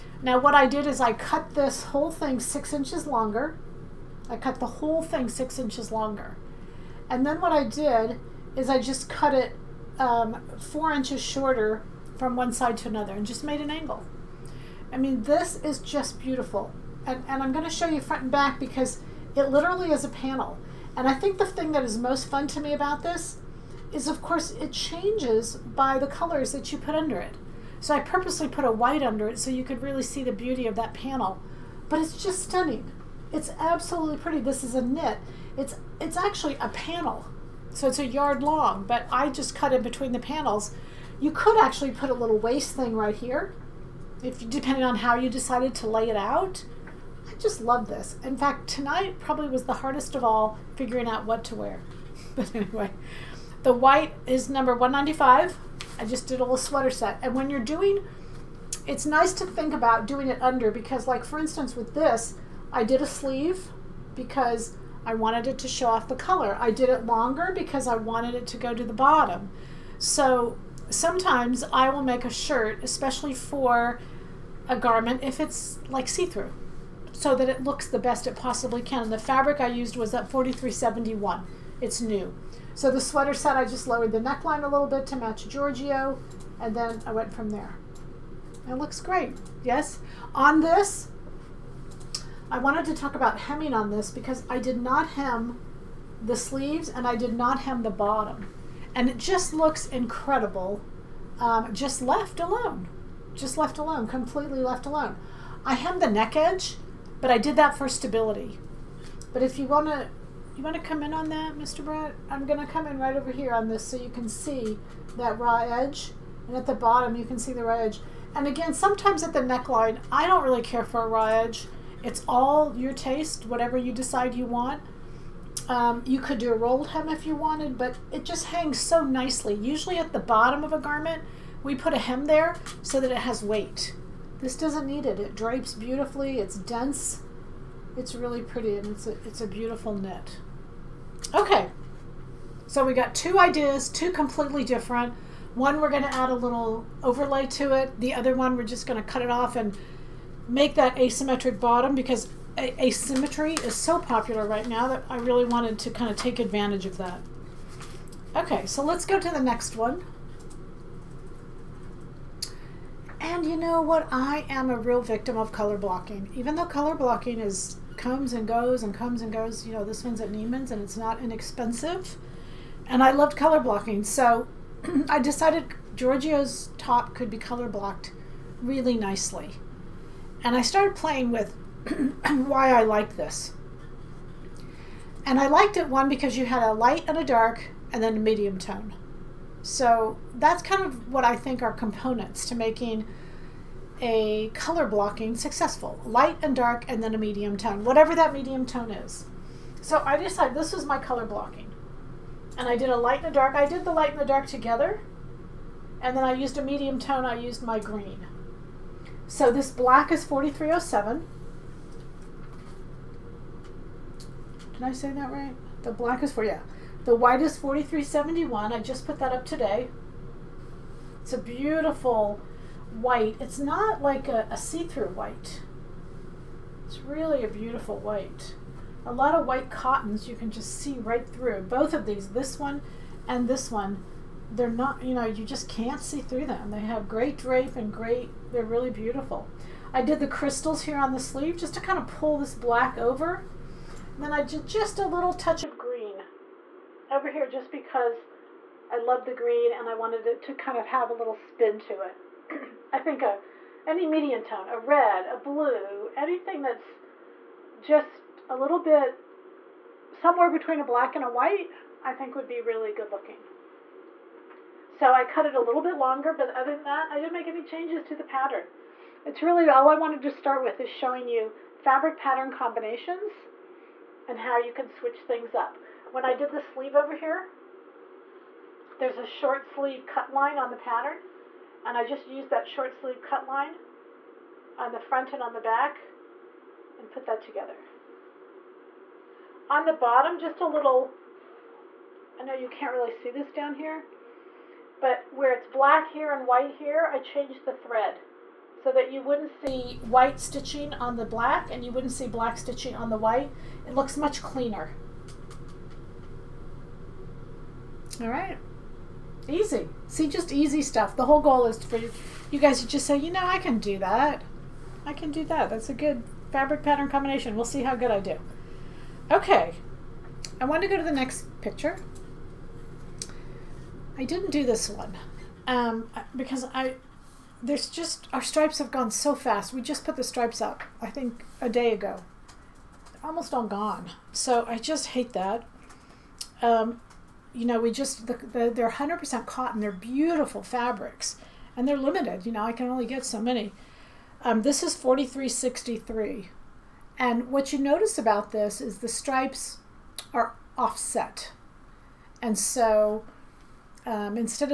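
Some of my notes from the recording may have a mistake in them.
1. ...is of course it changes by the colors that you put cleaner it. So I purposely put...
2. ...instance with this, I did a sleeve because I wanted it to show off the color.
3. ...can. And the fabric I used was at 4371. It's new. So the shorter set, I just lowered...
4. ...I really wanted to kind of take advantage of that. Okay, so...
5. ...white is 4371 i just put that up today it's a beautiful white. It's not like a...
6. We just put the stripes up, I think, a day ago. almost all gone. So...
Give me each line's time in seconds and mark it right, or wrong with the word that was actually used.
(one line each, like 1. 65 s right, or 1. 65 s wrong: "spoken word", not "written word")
1. 23 s wrong: "under", not "cleaner"
2. 61 s right
3. 78 s wrong: "sweater", not "shorter"
4. 155 s right
5. 217 s right
6. 329 s right.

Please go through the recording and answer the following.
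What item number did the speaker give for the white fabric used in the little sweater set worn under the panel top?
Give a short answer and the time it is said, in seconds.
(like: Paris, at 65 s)
195, at 54 s.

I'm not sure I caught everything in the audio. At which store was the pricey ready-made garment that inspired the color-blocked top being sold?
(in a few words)
Neiman's.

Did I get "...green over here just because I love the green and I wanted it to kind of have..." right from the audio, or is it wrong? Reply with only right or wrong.
right.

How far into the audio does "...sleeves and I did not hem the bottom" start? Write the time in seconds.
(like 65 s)
96 s.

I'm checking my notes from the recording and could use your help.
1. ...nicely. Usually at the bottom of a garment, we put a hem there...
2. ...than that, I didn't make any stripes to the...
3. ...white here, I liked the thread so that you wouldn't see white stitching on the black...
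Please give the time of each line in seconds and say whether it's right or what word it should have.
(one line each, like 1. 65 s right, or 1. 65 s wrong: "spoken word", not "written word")
1. 129 s right
2. 266 s wrong: "changes", not "stripes"
3. 296 s wrong: "changed", not "liked".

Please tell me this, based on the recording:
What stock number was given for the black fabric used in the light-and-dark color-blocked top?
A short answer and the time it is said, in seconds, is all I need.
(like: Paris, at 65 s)
4307, at 210 s.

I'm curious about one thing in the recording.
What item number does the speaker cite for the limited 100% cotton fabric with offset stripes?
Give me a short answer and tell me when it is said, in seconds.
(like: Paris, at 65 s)
4363, at 344 s.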